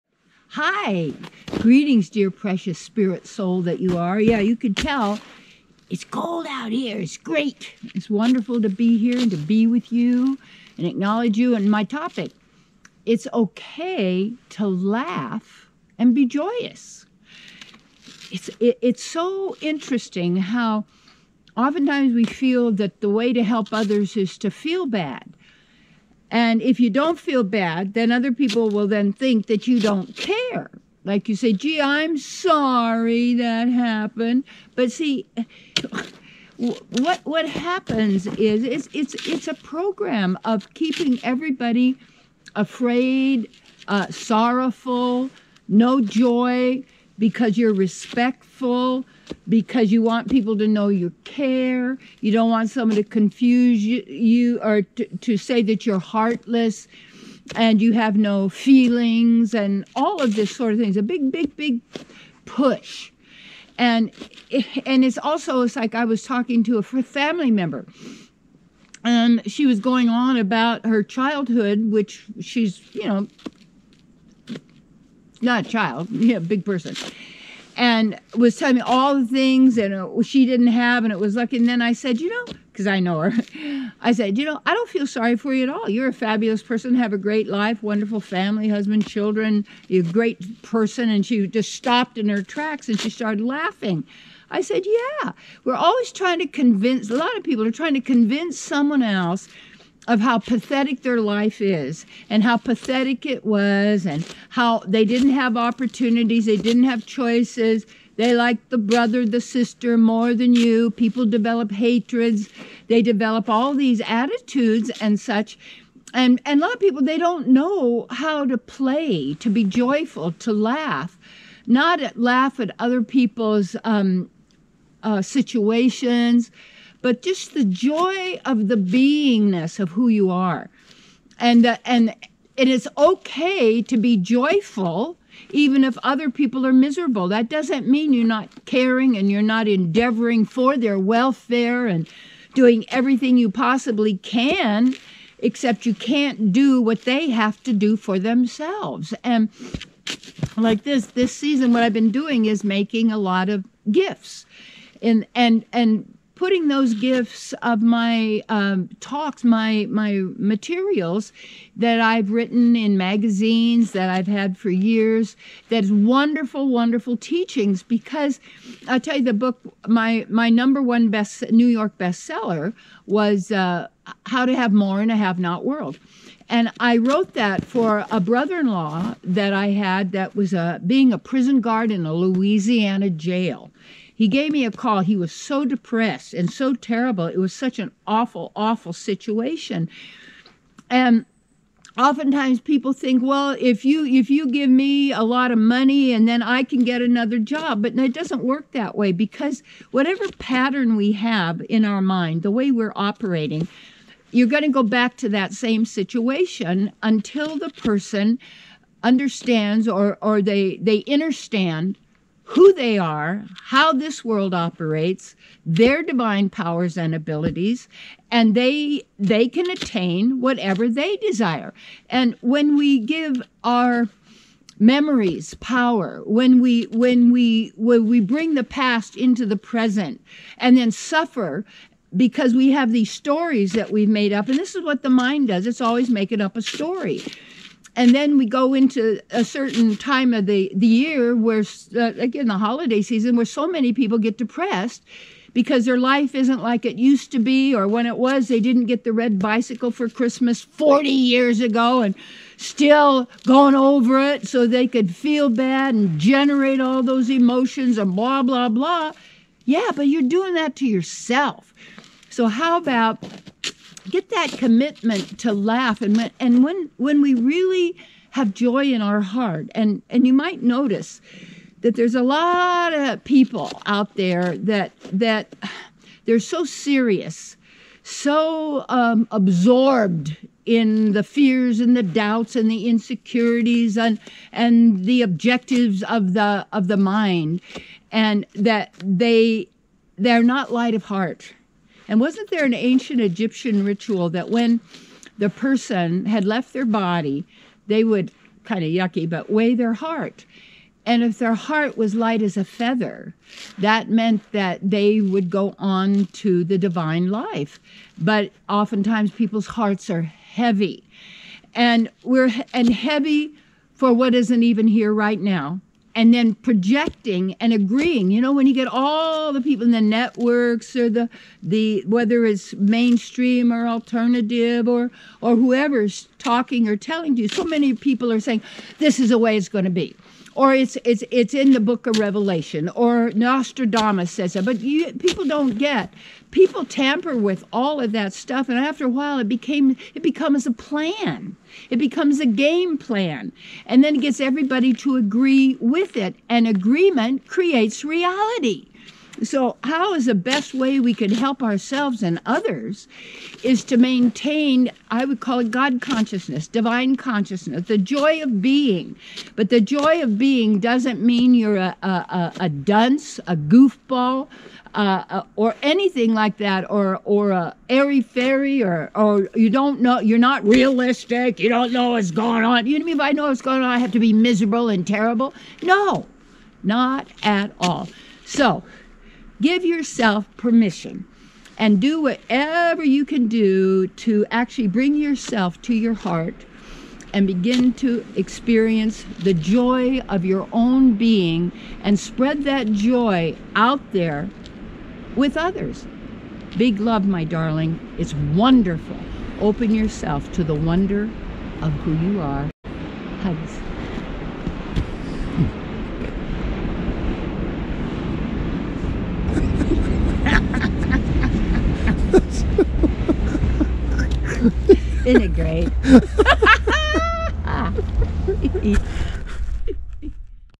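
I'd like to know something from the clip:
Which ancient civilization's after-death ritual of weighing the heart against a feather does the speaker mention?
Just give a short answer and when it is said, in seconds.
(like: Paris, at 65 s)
Egyptian, at 293 s.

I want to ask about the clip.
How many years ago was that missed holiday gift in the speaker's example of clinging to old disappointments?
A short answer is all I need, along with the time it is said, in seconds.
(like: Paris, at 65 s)
40, at 250 s.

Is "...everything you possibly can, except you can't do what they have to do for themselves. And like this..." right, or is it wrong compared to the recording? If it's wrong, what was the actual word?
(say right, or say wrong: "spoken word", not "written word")
right.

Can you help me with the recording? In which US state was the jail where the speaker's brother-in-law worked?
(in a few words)
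Louisiana.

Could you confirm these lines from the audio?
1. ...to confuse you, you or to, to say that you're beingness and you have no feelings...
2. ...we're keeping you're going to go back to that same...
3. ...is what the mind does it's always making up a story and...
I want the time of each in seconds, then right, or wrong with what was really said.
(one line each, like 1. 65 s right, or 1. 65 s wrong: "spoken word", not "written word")
1. 52 s wrong: "heartless", not "beingness"
2. 202 s wrong: "operating", not "keeping"
3. 234 s right.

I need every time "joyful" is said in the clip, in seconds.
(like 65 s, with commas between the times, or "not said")
119 s, 134 s.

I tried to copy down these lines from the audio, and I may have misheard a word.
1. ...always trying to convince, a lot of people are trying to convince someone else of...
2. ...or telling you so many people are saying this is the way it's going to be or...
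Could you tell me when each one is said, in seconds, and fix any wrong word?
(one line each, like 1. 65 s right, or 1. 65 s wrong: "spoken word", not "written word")
1. 95 s right
2. 326 s right.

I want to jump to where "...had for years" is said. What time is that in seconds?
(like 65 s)
164 s.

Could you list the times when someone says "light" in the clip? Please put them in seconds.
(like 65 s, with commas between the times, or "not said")
290 s, 302 s.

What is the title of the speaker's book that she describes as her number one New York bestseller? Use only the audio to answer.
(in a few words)
How to Have More in a Have Not World.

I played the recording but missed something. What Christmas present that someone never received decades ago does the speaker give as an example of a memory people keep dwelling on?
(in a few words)
Red bicycle.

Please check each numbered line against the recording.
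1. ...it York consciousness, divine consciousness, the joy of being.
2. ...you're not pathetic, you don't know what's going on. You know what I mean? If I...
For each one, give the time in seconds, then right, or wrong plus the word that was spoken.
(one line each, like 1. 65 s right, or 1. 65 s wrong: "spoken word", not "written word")
1. 355 s wrong: "God", not "York"
2. 370 s wrong: "realistic", not "pathetic".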